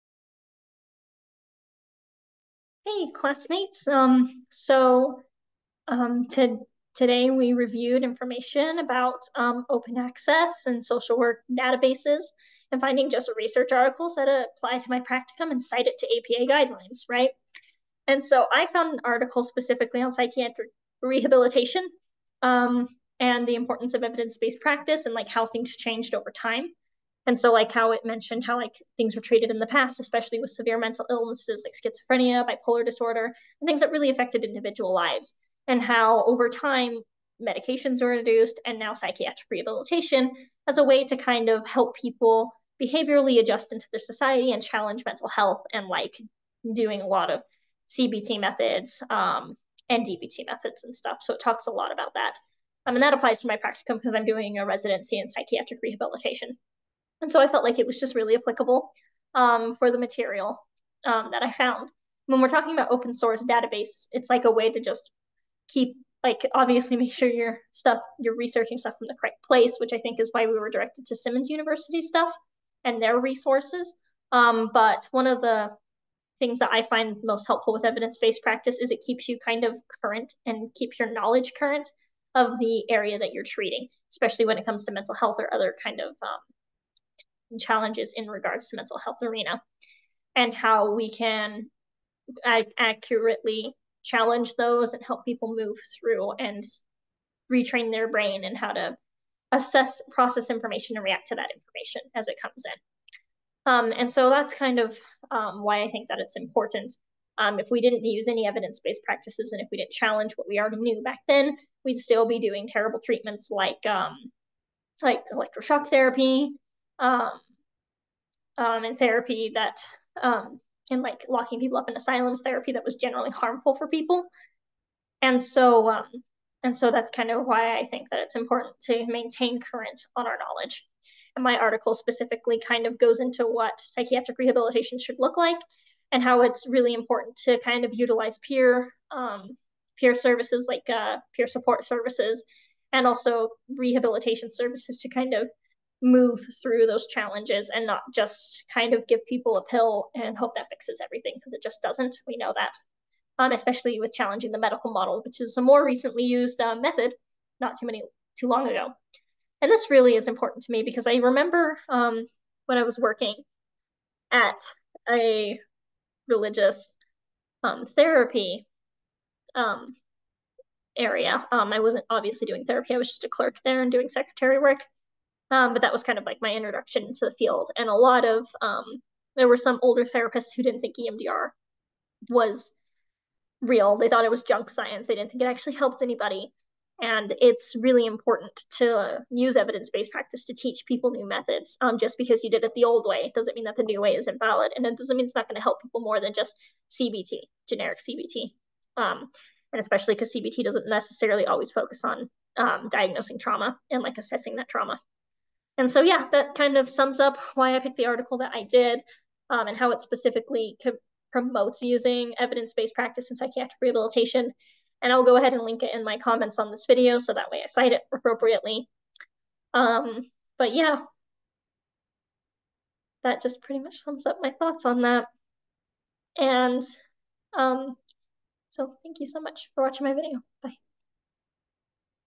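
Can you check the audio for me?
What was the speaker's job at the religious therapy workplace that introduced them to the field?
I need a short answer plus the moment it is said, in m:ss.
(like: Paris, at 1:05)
clerk, at 2:53.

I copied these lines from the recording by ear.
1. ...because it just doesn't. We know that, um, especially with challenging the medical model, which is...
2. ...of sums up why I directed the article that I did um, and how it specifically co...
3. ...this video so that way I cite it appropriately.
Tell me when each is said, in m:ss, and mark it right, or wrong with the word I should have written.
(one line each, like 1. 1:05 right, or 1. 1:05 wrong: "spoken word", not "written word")
1. 2:31 right
2. 3:26 wrong: "picked", not "directed"
3. 3:36 right.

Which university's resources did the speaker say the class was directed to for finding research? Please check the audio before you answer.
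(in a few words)
Simmons University.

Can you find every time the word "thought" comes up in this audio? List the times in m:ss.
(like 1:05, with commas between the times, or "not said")
3:04, 3:44.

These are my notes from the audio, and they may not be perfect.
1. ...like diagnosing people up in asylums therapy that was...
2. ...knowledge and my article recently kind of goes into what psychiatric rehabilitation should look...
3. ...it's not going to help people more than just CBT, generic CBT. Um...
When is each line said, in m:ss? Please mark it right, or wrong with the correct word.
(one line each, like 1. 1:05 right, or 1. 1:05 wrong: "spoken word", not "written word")
1. 2:01 wrong: "locking", not "diagnosing"
2. 2:10 wrong: "specifically", not "recently"
3. 3:15 right.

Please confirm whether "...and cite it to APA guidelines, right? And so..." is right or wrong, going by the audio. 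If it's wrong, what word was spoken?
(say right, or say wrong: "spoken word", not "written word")
right.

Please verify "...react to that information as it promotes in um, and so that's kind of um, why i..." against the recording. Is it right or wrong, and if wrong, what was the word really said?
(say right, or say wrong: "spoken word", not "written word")
wrong: "comes", not "promotes".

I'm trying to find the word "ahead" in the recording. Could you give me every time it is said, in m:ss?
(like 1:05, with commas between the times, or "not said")
3:35.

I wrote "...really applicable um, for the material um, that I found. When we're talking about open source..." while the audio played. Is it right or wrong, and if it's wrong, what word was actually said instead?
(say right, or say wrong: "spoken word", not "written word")
right.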